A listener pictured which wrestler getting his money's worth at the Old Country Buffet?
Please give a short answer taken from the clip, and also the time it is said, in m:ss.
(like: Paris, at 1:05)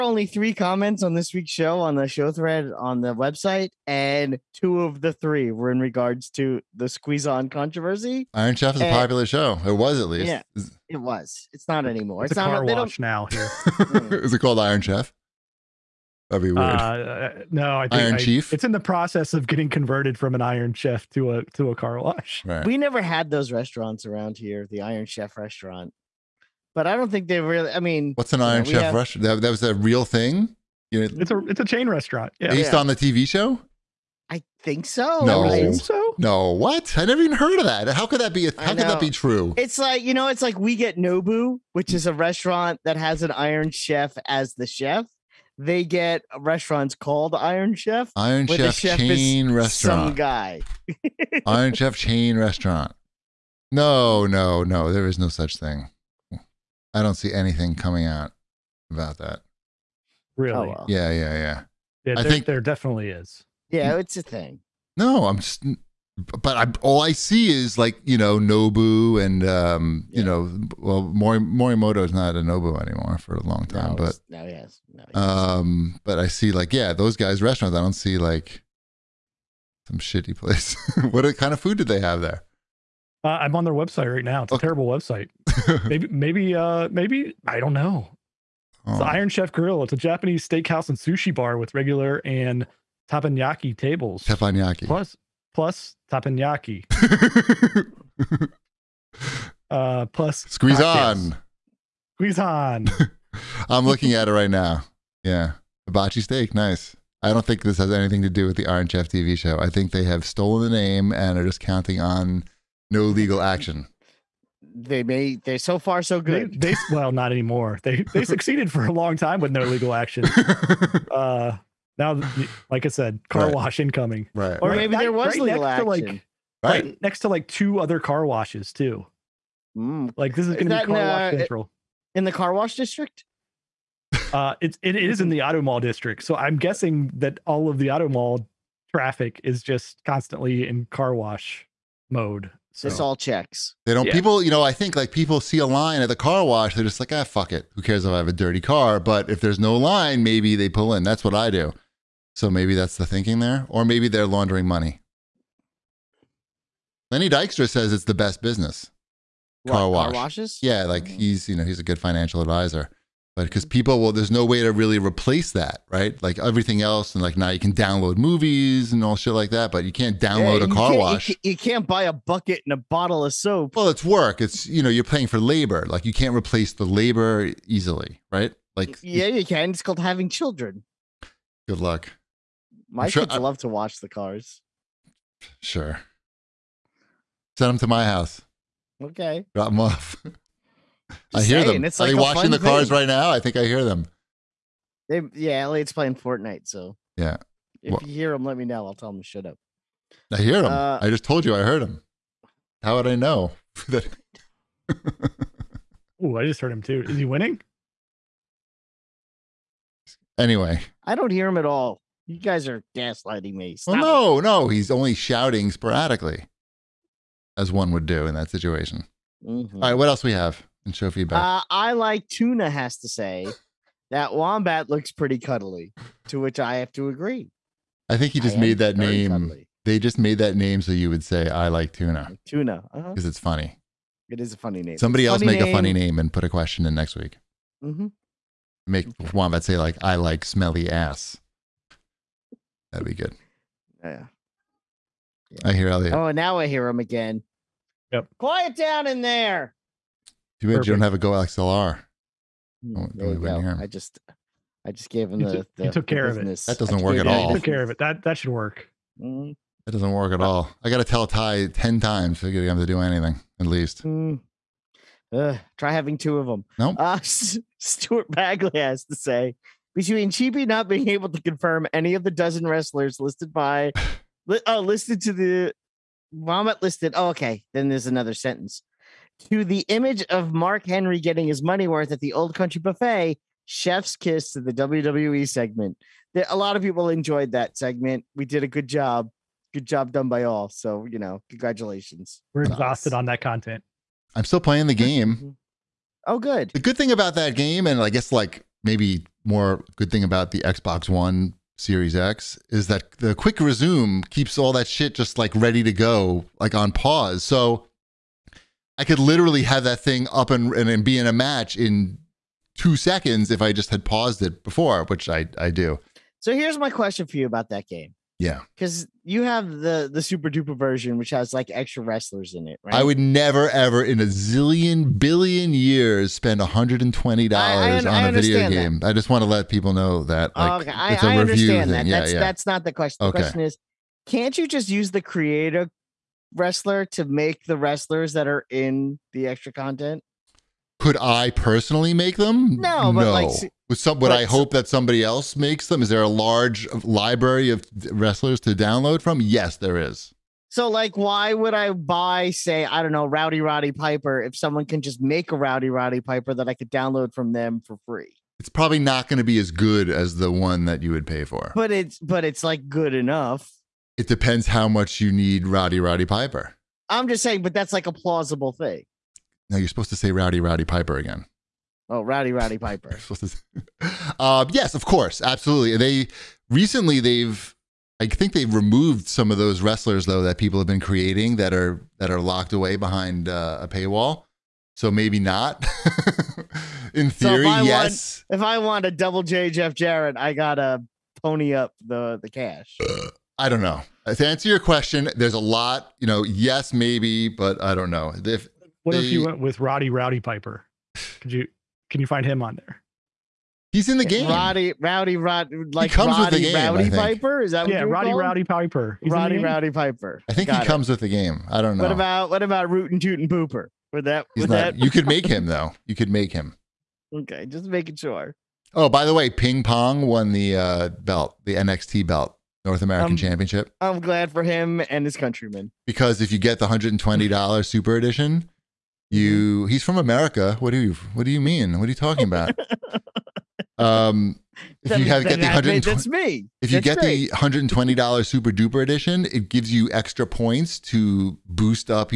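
Mark Henry, at 4:40.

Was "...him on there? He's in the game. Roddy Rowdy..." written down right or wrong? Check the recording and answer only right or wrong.
right.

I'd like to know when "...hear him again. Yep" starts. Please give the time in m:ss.
4:06.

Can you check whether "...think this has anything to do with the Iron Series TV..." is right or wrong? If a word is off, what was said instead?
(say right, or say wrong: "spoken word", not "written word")
wrong: "Chef", not "Series".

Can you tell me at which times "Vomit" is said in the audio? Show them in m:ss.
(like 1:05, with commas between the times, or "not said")
4:36.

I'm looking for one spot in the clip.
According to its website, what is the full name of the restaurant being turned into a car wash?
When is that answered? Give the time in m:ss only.
1:29.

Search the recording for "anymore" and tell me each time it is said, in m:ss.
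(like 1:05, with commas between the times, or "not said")
0:11, 1:12, 1:57.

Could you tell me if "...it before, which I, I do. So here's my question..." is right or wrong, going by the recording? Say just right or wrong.
right.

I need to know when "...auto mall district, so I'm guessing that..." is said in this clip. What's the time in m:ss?
2:15.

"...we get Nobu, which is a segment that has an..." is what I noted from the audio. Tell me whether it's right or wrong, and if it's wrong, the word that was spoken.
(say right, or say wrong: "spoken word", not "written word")
wrong: "restaurant", not "segment".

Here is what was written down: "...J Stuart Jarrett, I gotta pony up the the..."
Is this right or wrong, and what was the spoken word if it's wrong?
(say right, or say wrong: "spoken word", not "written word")
wrong: "Jeff", not "Stuart".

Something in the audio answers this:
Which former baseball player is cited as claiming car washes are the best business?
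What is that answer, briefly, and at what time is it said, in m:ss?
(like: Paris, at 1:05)
Lenny Dykstra, at 2:37.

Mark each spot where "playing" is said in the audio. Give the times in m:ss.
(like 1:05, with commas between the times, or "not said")
3:15, 4:54.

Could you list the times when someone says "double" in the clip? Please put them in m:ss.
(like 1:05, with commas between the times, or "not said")
6:29.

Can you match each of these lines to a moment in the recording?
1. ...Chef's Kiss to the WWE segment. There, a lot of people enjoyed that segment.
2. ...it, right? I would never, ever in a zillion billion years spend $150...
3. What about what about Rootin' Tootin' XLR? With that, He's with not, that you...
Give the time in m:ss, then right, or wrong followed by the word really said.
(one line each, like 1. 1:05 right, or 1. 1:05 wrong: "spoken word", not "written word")
1. 4:43 right
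2. 5:22 wrong: "120", not "150"
3. 6:52 wrong: "Pooper", not "XLR".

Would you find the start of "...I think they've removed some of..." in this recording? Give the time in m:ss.
6:18.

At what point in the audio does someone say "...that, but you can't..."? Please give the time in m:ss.
2:49.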